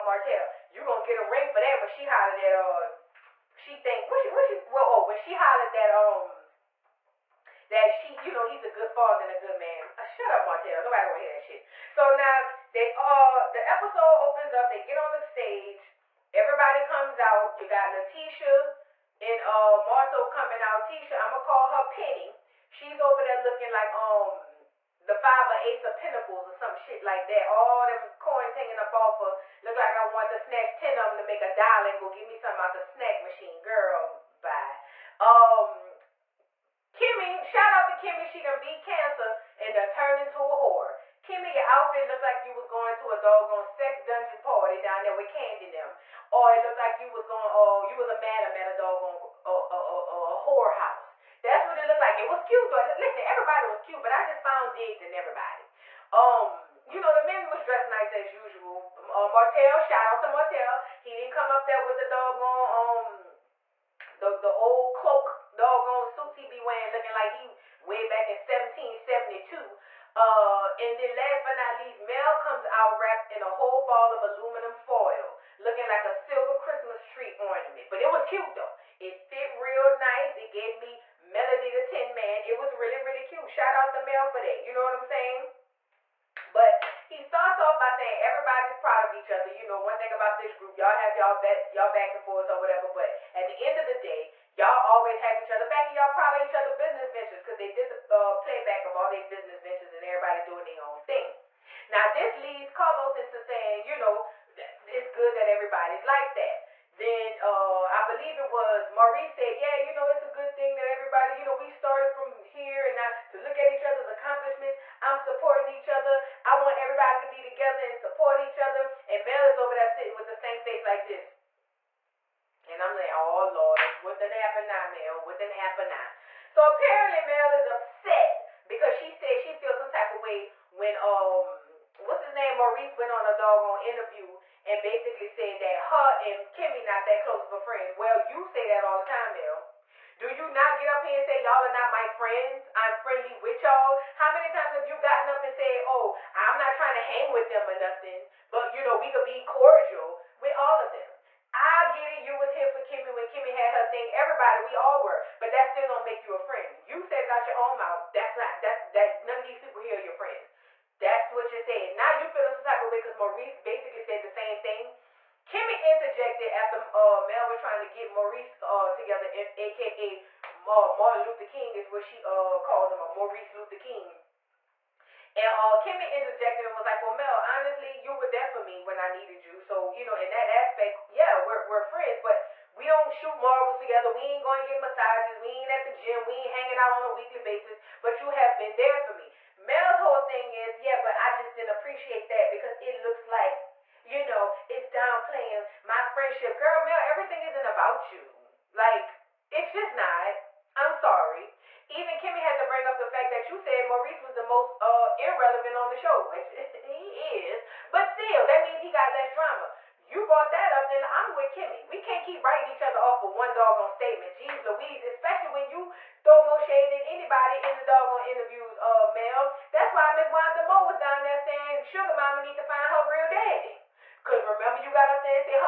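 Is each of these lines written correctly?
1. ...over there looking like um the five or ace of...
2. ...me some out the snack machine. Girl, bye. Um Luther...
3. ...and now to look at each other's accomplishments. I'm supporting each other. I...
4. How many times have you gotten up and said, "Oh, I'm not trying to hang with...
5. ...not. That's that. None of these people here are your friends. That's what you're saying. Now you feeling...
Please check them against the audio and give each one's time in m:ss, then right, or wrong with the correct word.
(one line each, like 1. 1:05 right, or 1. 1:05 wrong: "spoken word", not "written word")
1. 0:22 right
2. 0:32 wrong: "Kimmy", not "Luther"
3. 1:52 right
4. 2:24 right
5. 2:38 right.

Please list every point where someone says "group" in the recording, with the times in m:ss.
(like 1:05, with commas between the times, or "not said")
1:30.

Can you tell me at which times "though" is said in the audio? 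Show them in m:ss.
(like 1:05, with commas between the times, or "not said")
0:52, 1:18.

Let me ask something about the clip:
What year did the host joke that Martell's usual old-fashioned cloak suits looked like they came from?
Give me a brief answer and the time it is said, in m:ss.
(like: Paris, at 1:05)
1772, at 1:08.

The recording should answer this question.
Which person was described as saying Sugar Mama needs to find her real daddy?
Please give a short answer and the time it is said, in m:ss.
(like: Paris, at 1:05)
Wanda Moore, at 3:40.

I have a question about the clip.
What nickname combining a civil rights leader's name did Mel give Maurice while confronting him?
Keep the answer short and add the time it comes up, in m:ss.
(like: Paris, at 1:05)
Maurice Luther King, at 2:53.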